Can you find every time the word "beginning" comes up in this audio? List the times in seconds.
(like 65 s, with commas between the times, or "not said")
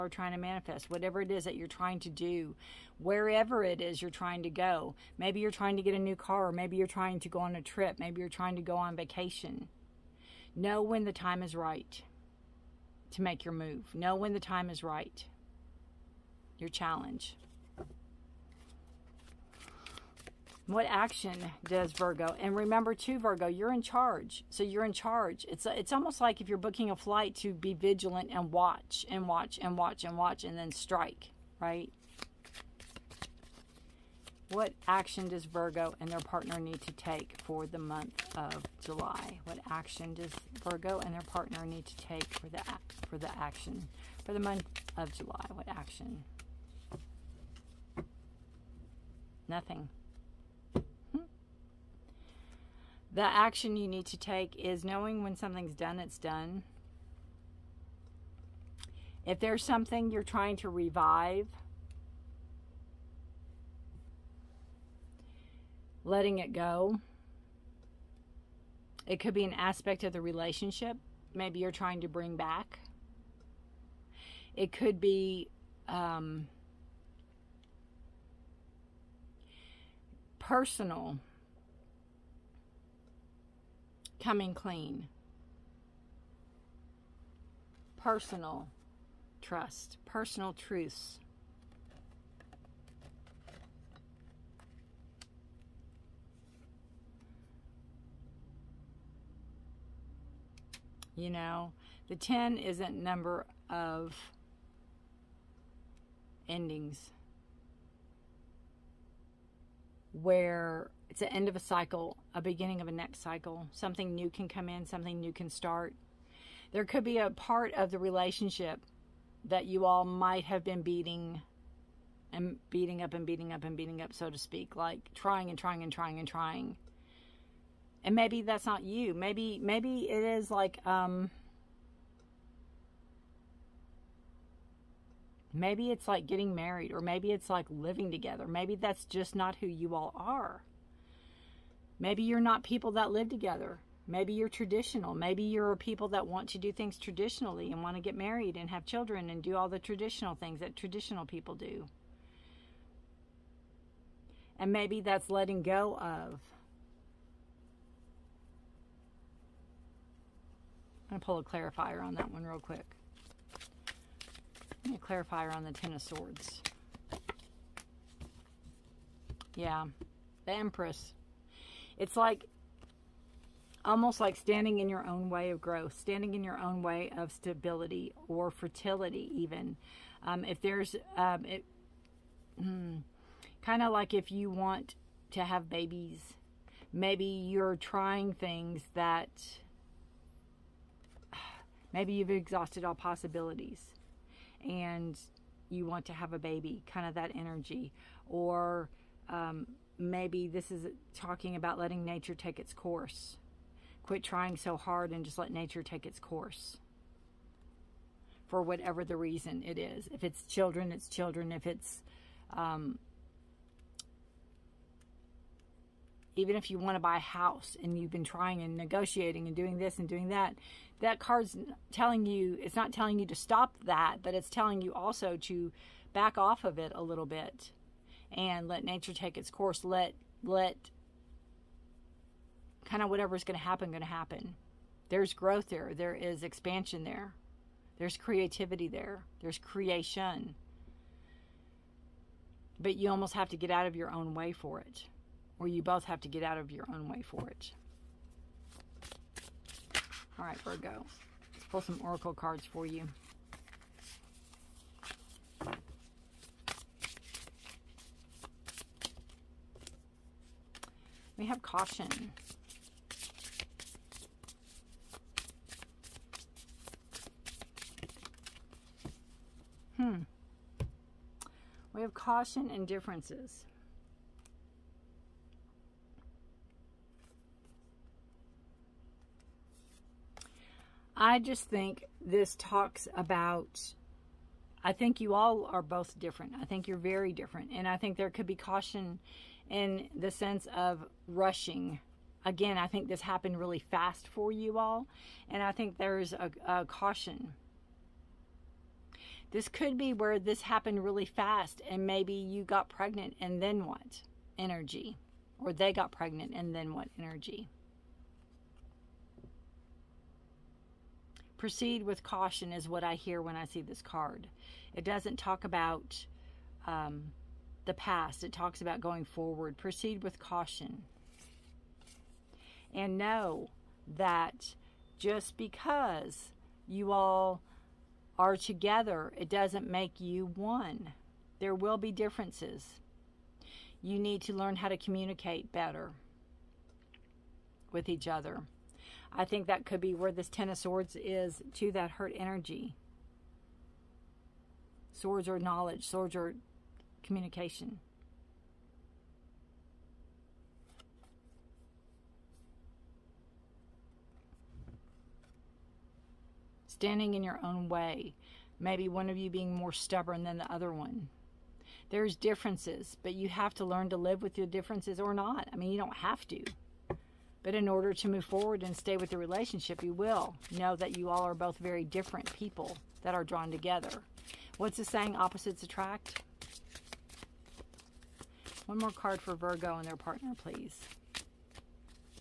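112 s.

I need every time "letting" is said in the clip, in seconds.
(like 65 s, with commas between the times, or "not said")
66 s, 155 s, 201 s.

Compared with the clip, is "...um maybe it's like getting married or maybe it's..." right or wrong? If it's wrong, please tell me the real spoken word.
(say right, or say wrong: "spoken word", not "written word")
right.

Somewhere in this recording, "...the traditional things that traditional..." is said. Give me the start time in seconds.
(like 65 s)
149 s.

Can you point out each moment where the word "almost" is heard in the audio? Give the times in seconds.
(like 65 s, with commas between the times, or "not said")
25 s, 173 s, 243 s.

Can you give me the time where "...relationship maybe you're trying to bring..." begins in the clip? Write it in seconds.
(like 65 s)
70 s.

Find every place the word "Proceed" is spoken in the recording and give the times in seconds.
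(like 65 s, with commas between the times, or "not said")
311 s, 319 s.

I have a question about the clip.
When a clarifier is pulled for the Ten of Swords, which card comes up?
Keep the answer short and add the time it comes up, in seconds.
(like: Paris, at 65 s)
The Empress, at 170 s.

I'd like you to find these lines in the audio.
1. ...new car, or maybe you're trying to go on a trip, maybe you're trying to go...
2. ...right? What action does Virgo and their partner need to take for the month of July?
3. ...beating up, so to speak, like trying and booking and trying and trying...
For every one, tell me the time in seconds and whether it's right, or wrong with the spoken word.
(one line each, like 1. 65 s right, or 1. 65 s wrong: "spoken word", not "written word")
1. 5 s right
2. 31 s right
3. 123 s wrong: "trying", not "booking".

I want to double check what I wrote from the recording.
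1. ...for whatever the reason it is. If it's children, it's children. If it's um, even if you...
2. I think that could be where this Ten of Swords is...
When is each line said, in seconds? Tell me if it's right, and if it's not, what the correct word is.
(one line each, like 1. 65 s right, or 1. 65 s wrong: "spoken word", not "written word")
1. 208 s right
2. 339 s right.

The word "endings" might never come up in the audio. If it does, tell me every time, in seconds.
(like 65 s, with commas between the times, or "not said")
106 s.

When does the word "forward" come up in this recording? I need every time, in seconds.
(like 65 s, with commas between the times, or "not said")
319 s, 368 s.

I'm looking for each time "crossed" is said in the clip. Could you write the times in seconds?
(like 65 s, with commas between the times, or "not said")
not said.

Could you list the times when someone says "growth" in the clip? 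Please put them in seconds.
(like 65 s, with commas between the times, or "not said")
175 s, 235 s.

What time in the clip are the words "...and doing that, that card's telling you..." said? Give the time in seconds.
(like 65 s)
219 s.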